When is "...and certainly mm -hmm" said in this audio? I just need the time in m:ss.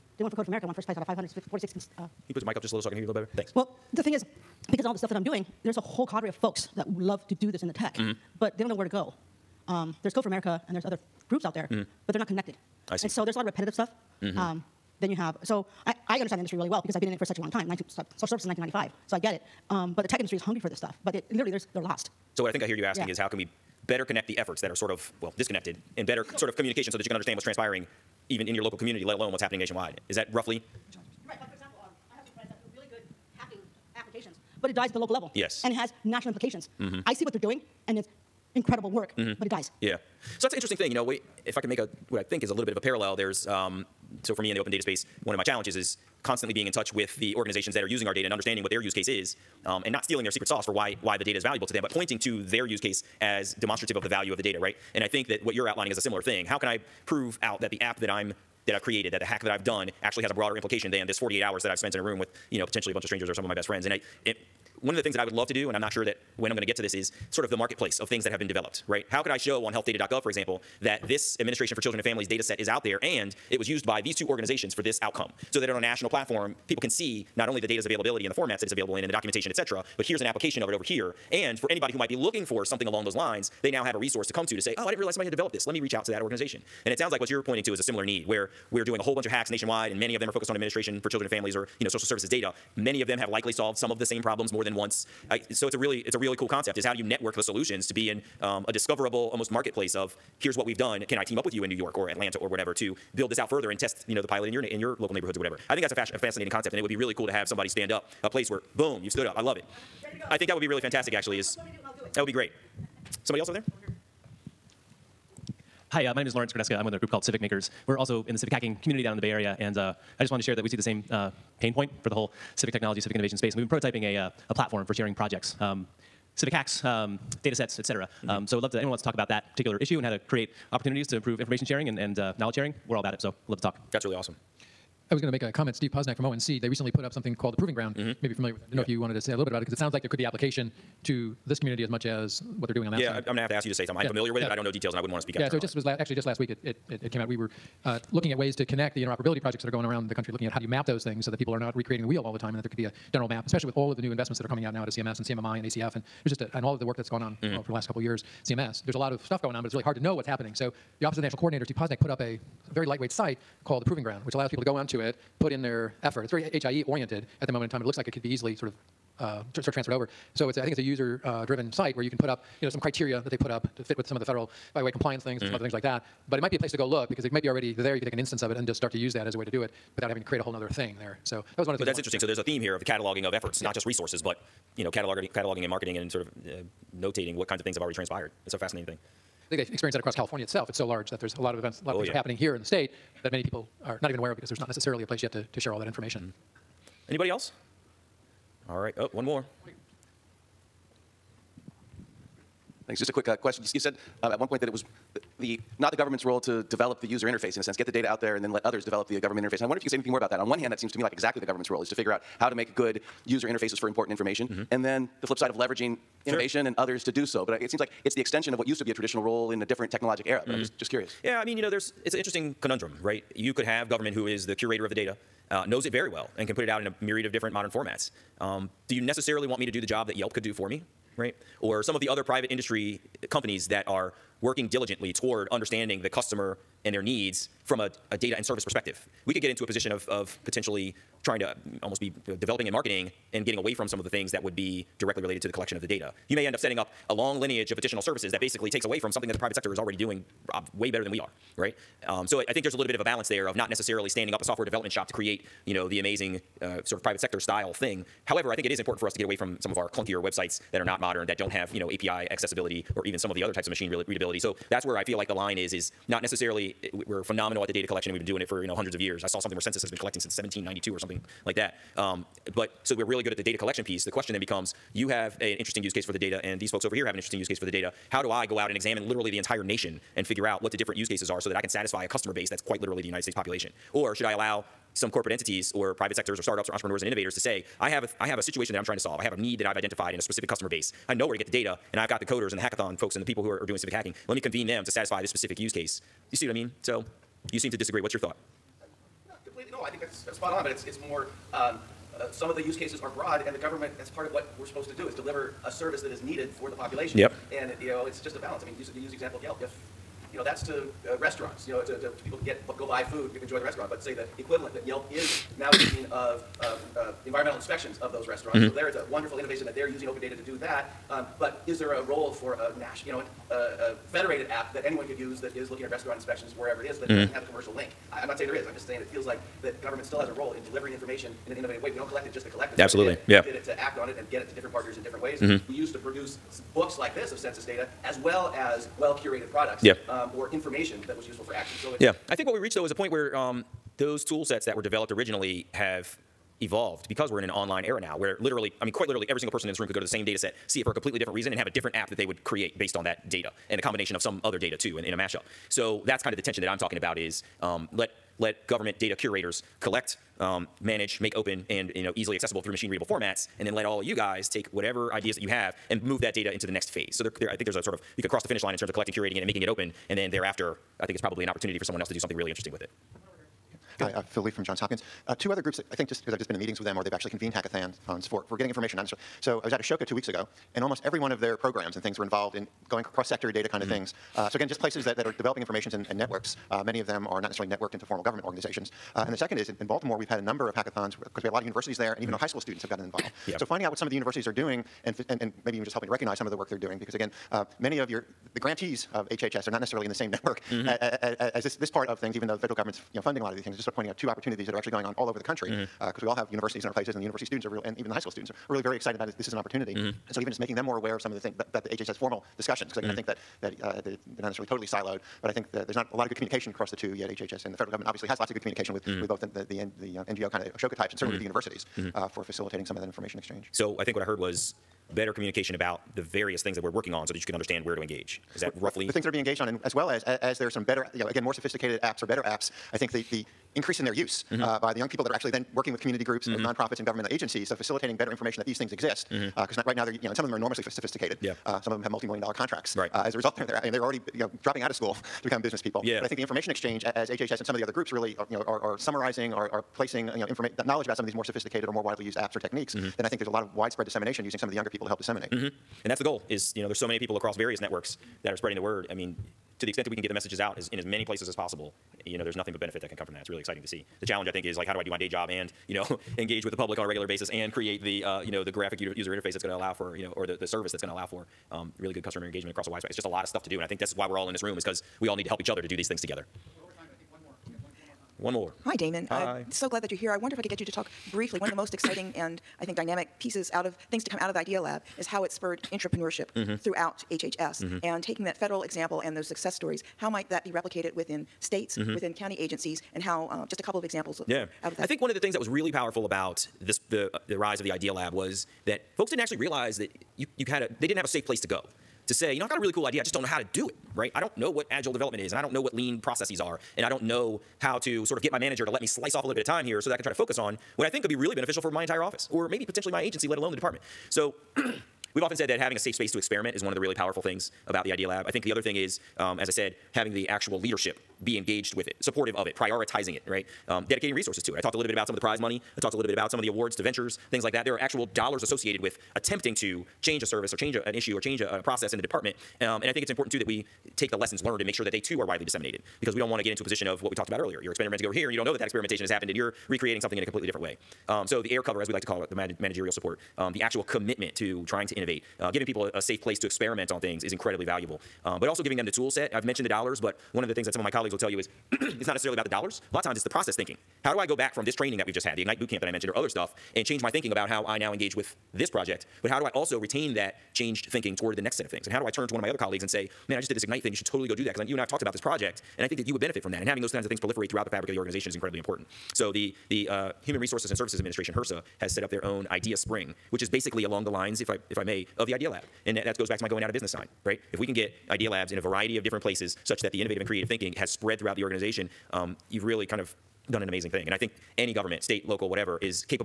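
7:01.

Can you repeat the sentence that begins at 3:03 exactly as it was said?
not just resources, but you know, cataloging, cataloging and marketing and sort of uh, notating what kinds of things have already transpired.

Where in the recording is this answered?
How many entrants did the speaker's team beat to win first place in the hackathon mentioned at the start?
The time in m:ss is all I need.
0:01.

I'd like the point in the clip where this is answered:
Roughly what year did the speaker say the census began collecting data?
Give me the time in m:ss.
4:30.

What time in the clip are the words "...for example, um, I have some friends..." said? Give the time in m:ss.
0:31.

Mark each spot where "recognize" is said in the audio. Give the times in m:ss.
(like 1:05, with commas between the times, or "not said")
6:36.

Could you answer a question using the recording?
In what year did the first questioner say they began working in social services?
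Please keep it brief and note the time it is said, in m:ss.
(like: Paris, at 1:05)
1995, at 0:18.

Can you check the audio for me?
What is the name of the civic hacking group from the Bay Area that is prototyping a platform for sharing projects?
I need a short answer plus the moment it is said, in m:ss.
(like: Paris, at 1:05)
Civic Makers, at 1:57.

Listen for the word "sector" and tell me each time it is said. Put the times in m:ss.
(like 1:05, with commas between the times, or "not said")
4:09, 4:17, 4:46, 6:23.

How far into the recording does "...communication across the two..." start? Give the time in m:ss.
6:56.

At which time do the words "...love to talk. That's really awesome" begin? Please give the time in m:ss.
2:13.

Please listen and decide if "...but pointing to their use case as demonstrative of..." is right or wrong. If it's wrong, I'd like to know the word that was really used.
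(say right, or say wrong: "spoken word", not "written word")
right.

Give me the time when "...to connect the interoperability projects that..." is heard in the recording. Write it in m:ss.
2:28.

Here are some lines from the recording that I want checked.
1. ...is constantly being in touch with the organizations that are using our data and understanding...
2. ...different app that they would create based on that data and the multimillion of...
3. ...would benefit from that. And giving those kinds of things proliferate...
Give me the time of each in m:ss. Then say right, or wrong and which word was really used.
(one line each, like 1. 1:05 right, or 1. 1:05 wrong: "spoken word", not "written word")
1. 0:45 right
2. 5:51 wrong: "combination", not "multimillion"
3. 9:26 wrong: "having", not "giving".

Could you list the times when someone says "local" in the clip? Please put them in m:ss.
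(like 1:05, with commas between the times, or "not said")
0:28, 0:34, 1:44, 9:45.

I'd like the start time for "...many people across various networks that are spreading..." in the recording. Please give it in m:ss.
7:37.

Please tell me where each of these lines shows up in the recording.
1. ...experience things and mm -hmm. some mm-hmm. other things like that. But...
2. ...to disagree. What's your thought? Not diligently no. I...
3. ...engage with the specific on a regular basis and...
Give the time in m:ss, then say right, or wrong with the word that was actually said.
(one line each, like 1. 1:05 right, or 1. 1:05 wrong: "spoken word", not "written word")
1. 2:54 wrong: "compliance", not "experience"
2. 4:57 wrong: "completely", not "diligently"
3. 7:46 wrong: "public", not "specific".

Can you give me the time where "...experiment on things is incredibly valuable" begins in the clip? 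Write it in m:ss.
9:06.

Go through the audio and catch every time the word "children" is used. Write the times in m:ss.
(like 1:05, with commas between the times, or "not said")
1:11, 1:31.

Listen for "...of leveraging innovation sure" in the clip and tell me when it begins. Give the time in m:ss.
3:35.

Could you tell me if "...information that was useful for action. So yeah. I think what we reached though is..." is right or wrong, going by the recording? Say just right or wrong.
right.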